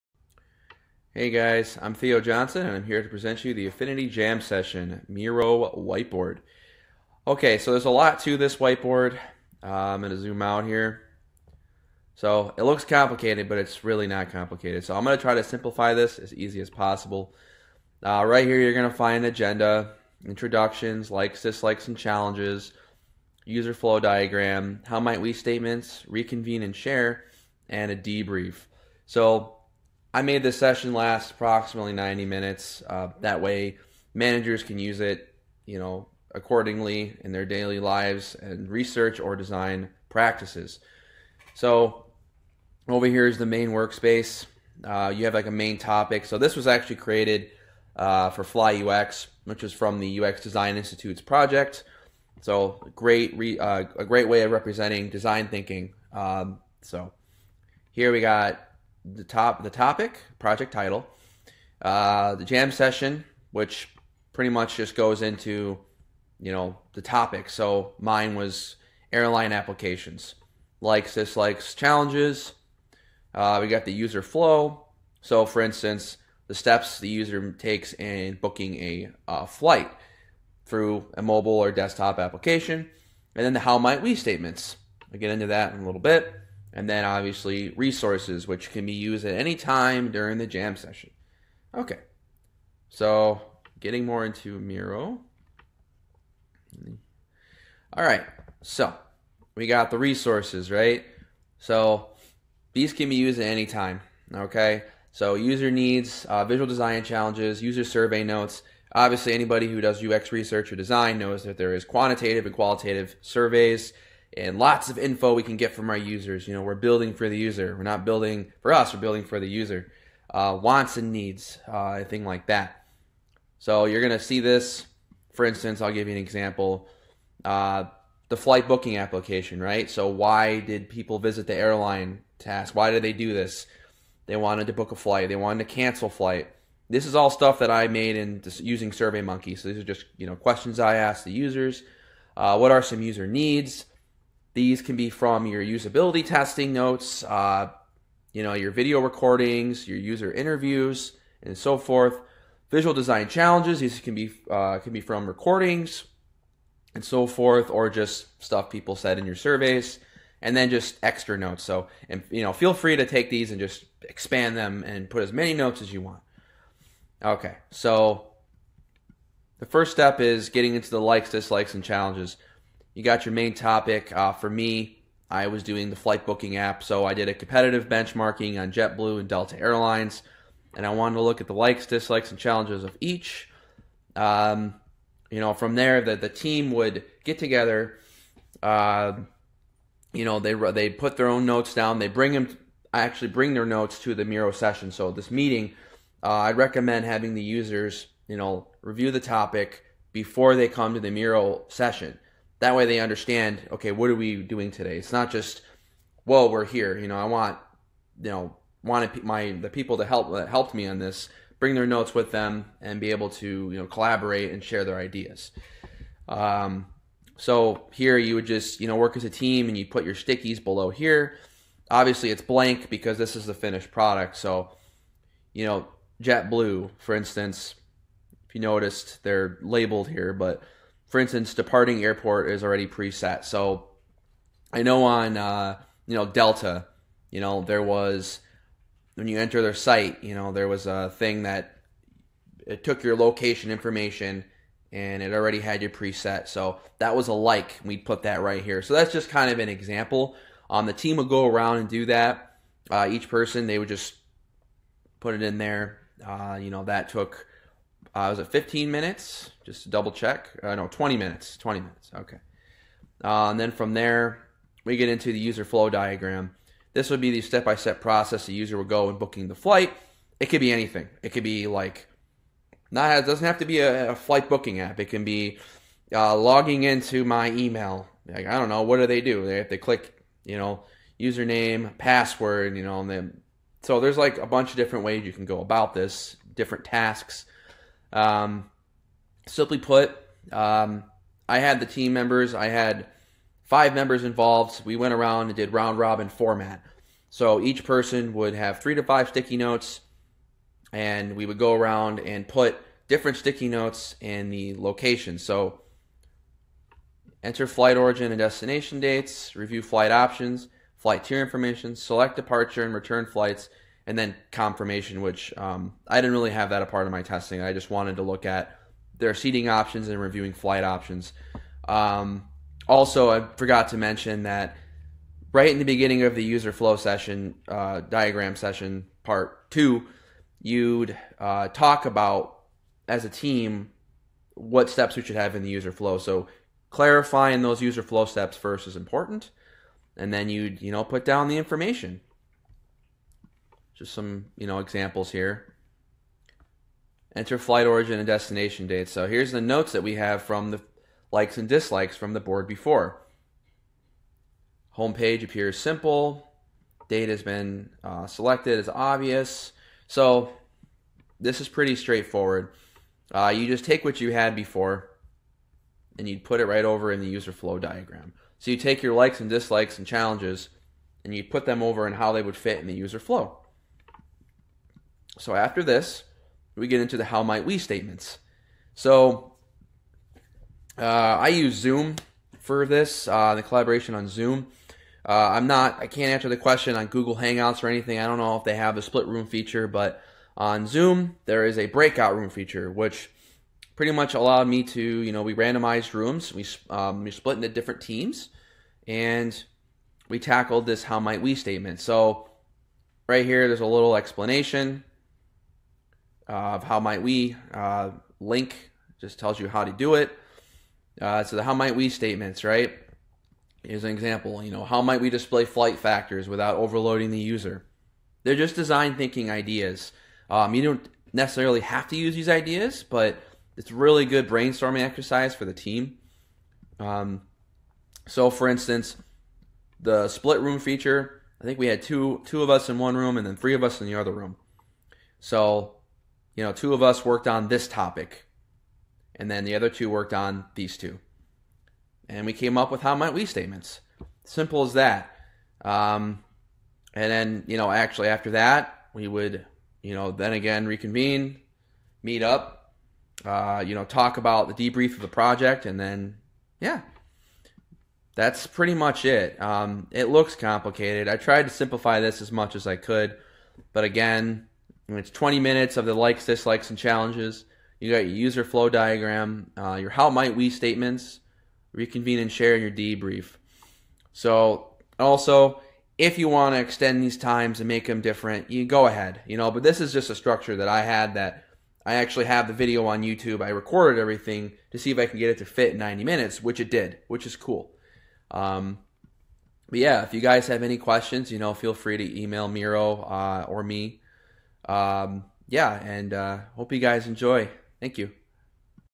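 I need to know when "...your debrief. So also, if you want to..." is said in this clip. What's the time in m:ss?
7:52.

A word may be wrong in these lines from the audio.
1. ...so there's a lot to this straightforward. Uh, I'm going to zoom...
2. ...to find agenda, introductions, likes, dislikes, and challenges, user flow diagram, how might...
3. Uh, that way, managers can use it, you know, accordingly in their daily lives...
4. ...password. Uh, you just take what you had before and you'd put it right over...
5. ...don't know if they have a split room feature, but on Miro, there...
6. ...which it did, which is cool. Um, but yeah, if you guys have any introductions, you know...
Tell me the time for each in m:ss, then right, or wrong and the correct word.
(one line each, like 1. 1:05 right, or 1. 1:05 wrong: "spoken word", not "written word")
1. 0:07 wrong: "whiteboard", not "straightforward"
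2. 0:18 right
3. 0:32 right
4. 6:01 wrong: "straightforward", not "password"
5. 6:28 wrong: "Zoom", not "Miro"
6. 8:06 wrong: "questions", not "introductions".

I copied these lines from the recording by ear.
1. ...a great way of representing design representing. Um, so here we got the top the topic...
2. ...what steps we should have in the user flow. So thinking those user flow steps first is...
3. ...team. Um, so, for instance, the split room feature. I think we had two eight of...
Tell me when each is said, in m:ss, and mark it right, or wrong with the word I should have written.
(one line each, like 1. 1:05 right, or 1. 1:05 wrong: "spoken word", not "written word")
1. 0:53 wrong: "thinking", not "representing"
2. 5:34 wrong: "clarifying", not "thinking"
3. 7:05 wrong: "two", not "eight".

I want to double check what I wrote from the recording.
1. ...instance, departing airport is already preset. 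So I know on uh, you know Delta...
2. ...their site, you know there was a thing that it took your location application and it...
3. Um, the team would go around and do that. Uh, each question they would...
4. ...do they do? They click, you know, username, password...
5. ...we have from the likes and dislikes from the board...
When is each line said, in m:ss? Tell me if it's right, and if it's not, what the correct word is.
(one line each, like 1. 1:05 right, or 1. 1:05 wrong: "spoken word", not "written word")
1. 3:51 right
2. 3:59 wrong: "information", not "application"
3. 4:10 wrong: "person", not "question"
4. 4:38 right
5. 5:50 right.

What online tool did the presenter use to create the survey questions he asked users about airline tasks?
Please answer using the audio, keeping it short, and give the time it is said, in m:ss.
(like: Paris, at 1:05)
SurveyMonkey, at 2:18.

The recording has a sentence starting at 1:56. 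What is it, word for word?
You know, we're building for the user.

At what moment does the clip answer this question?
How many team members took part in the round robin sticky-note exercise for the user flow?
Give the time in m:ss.
4:53.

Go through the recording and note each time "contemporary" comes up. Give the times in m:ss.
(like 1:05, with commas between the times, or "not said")
not said.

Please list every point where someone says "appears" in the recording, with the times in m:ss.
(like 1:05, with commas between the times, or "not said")
5:55.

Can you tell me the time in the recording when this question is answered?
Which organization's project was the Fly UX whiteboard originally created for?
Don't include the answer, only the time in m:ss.
0:50.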